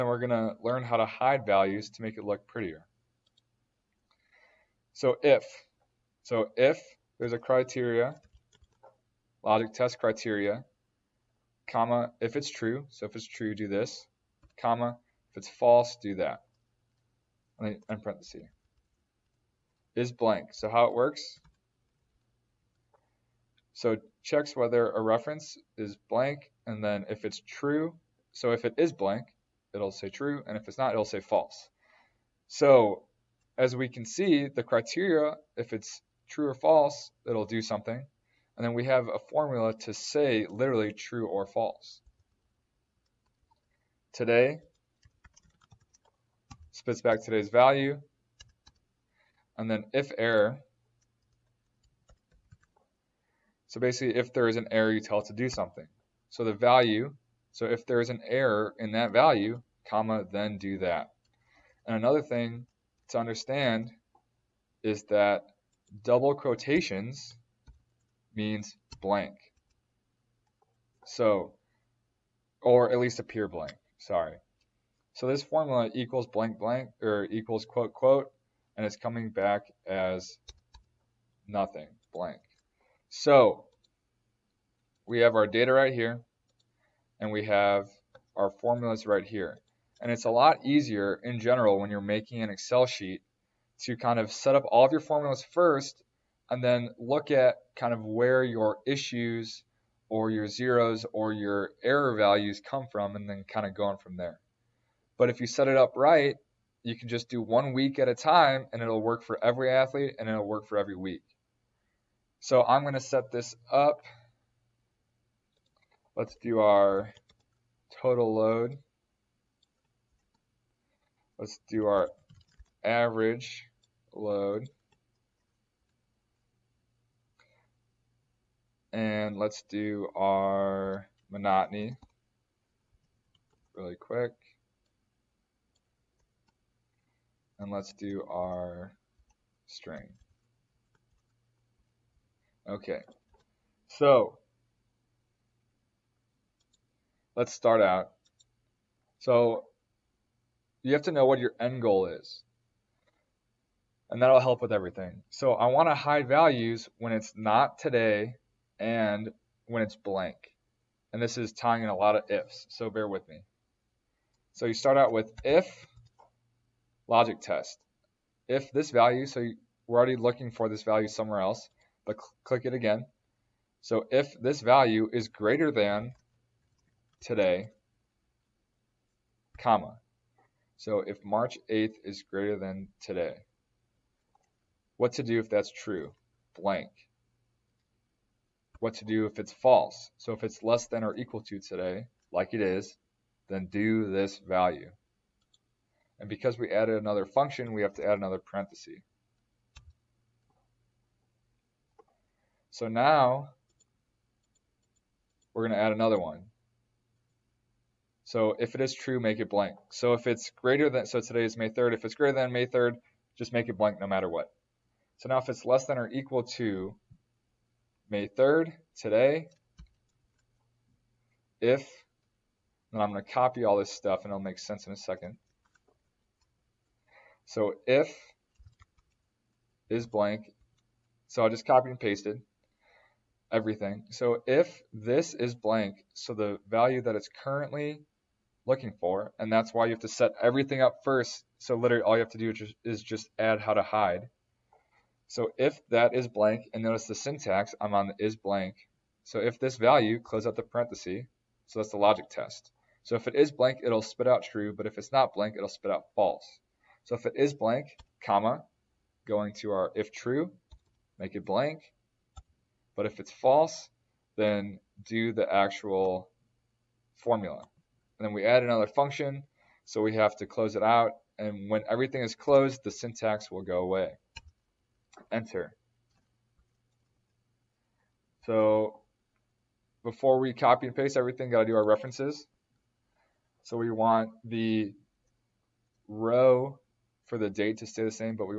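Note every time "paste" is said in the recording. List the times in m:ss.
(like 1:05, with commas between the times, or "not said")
3:51, 4:40.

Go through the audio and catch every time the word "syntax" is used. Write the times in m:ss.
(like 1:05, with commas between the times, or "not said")
4:07, 4:32.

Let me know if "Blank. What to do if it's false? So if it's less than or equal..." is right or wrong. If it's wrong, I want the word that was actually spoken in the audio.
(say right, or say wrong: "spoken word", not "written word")
right.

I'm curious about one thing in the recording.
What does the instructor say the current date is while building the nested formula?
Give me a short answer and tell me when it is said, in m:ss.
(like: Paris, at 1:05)
May 3rd, at 3:31.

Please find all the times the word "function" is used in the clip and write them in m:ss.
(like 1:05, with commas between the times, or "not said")
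3:17, 4:28.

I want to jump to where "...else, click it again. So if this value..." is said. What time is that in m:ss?
2:51.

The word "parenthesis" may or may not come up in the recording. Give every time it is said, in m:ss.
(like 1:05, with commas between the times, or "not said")
0:18, 3:18, 4:10.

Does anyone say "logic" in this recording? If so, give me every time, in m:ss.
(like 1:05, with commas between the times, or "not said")
0:09, 2:47, 4:11.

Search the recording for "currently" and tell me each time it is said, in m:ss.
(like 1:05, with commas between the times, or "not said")
3:57.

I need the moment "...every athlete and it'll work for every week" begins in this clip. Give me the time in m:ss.
1:49.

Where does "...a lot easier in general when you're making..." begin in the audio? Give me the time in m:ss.
1:30.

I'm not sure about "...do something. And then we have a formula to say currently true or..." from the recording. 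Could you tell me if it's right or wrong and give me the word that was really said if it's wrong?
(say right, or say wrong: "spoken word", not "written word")
wrong: "literally", not "currently".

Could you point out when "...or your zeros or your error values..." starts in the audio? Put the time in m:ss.
1:40.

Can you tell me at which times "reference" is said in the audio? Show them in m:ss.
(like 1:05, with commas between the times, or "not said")
0:25, 4:41.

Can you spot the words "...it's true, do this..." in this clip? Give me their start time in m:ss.
0:13.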